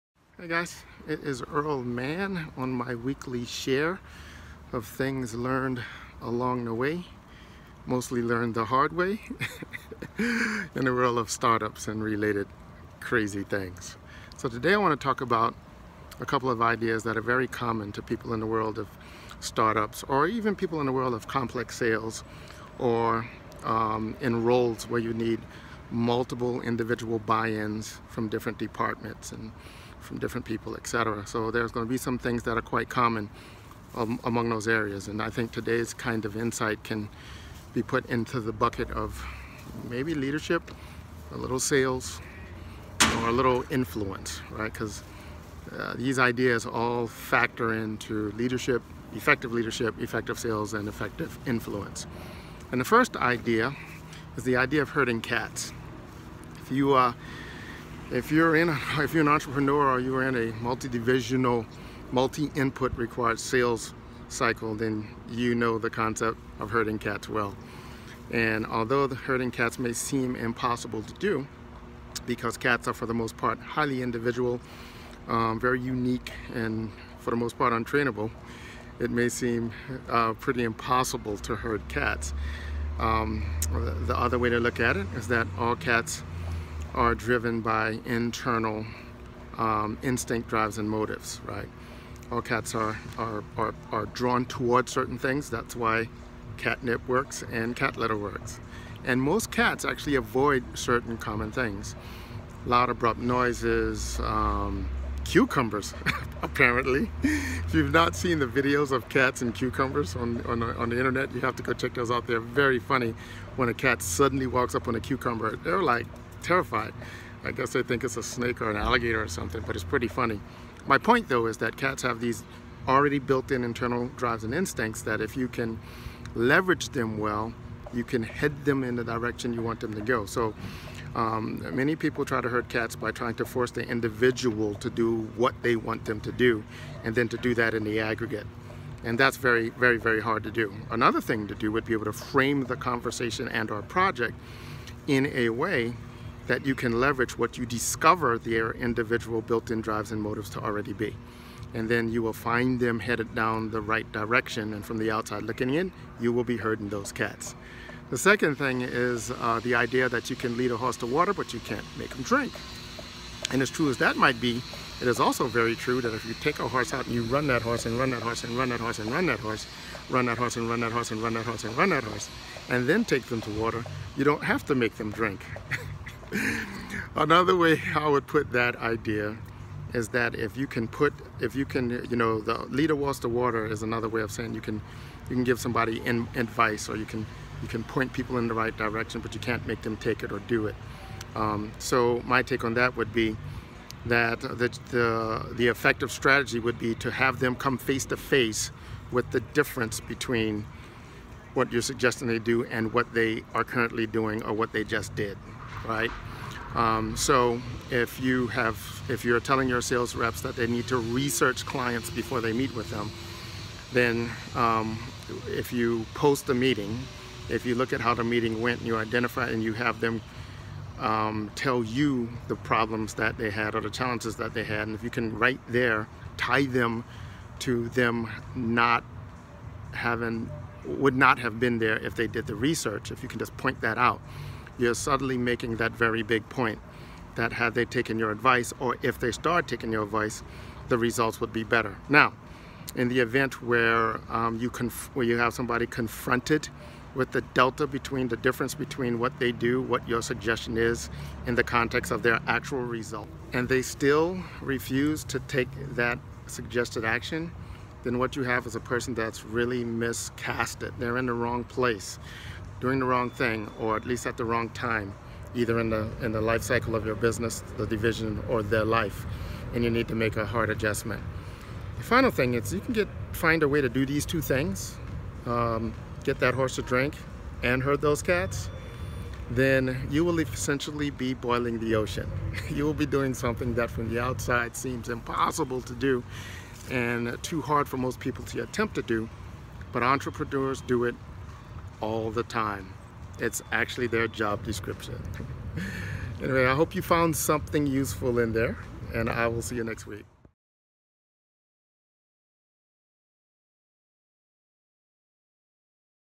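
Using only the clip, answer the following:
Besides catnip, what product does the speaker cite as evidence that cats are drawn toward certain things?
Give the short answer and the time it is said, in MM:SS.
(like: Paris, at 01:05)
Cat litter, at 01:37.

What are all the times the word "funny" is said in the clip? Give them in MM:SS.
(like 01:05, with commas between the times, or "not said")
01:52, 02:00.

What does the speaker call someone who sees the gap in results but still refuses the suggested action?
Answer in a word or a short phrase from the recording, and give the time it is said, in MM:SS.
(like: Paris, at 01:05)
Miscasted, at 04:19.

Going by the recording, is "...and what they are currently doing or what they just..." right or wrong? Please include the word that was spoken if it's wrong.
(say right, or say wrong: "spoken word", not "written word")
right.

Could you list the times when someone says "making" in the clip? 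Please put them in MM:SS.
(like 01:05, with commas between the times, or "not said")
03:55.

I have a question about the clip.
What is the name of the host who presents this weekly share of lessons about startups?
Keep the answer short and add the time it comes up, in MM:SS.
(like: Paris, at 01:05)
Earl Mann, at 00:01.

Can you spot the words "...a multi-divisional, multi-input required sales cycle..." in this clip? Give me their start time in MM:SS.
01:00.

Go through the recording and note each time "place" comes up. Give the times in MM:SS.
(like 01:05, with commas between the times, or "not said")
04:21.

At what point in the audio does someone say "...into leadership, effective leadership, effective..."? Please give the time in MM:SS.
00:47.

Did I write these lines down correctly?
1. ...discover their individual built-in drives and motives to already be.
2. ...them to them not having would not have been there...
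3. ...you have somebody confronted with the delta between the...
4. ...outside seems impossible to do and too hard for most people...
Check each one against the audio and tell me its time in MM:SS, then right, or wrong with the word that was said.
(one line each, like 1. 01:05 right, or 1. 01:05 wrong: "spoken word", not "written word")
1. 02:27 right
2. 03:46 right
3. 04:05 right
4. 04:44 right.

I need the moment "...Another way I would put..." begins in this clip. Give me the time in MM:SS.
02:57.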